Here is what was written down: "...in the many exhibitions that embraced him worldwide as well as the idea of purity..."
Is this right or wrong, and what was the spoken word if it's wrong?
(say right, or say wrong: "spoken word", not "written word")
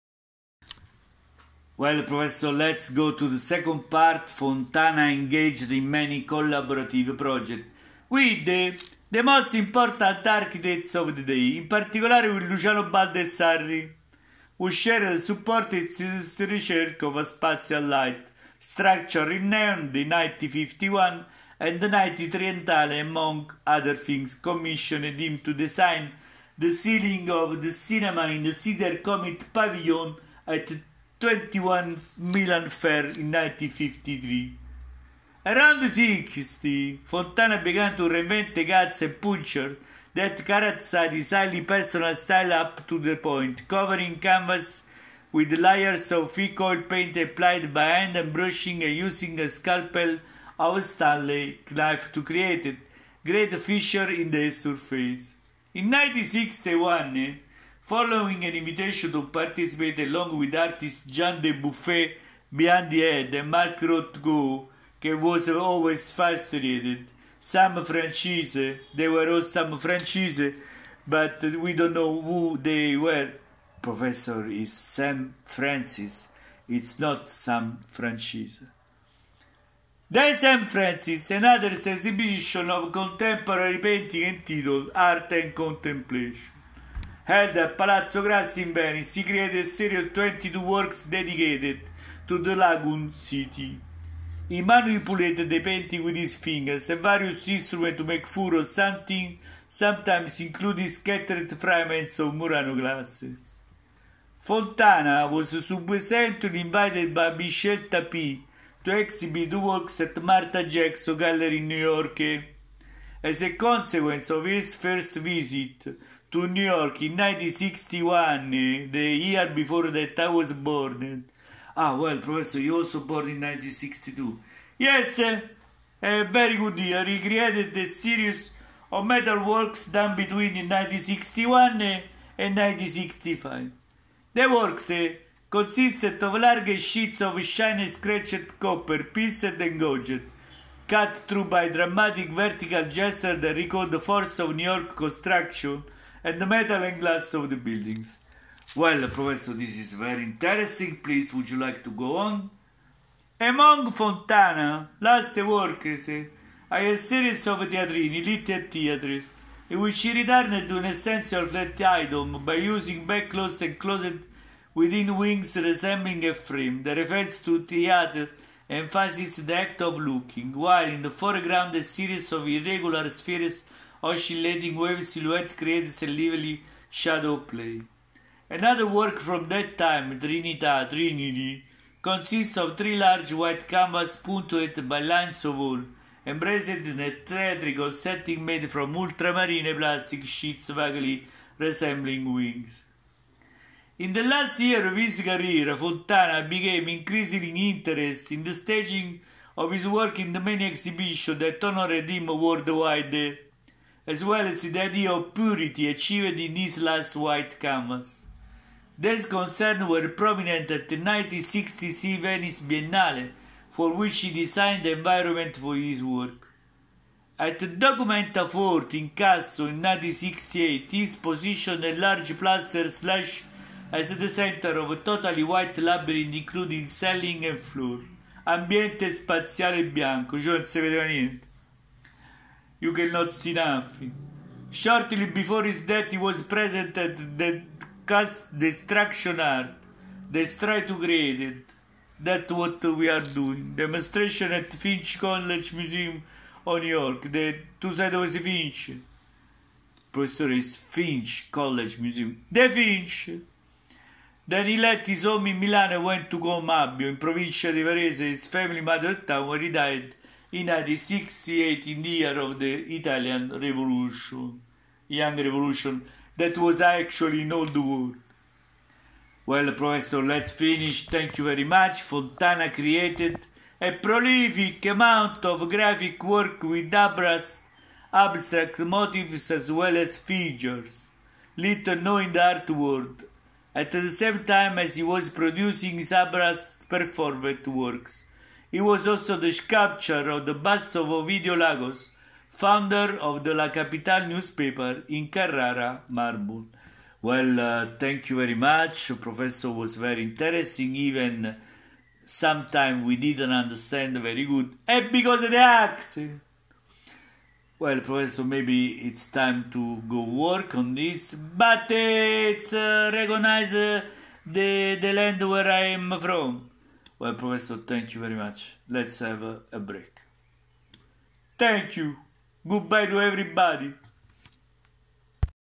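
wrong: "honored", not "embraced".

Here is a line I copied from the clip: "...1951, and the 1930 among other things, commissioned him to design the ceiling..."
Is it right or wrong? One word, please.
right.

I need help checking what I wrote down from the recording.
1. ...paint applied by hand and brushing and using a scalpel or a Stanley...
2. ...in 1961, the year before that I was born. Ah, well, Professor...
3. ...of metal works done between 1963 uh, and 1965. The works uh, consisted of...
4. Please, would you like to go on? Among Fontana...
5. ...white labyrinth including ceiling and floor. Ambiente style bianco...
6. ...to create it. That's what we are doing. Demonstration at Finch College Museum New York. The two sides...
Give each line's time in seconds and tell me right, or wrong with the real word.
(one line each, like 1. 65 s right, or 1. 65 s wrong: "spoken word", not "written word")
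1. 46 s right
2. 117 s right
3. 128 s wrong: "1961", not "1963"
4. 151 s right
5. 225 s wrong: "spaziale", not "style"
6. 240 s right.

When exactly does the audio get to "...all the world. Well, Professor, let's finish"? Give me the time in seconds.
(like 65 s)
267 s.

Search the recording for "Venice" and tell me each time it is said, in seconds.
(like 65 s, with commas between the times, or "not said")
88 s, 212 s.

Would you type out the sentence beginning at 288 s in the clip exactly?
He was also the sculptor of the bust of Ovidio Lagos, founder of the La Capital newspaper in Carrara, Marble.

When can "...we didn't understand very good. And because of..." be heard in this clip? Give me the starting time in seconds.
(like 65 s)
303 s.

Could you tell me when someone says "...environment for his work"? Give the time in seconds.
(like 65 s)
214 s.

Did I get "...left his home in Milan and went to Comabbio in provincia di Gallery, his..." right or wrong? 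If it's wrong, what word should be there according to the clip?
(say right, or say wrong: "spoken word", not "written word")
wrong: "Varese", not "Gallery".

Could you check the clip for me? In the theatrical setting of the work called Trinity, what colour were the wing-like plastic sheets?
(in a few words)
Ultramarine.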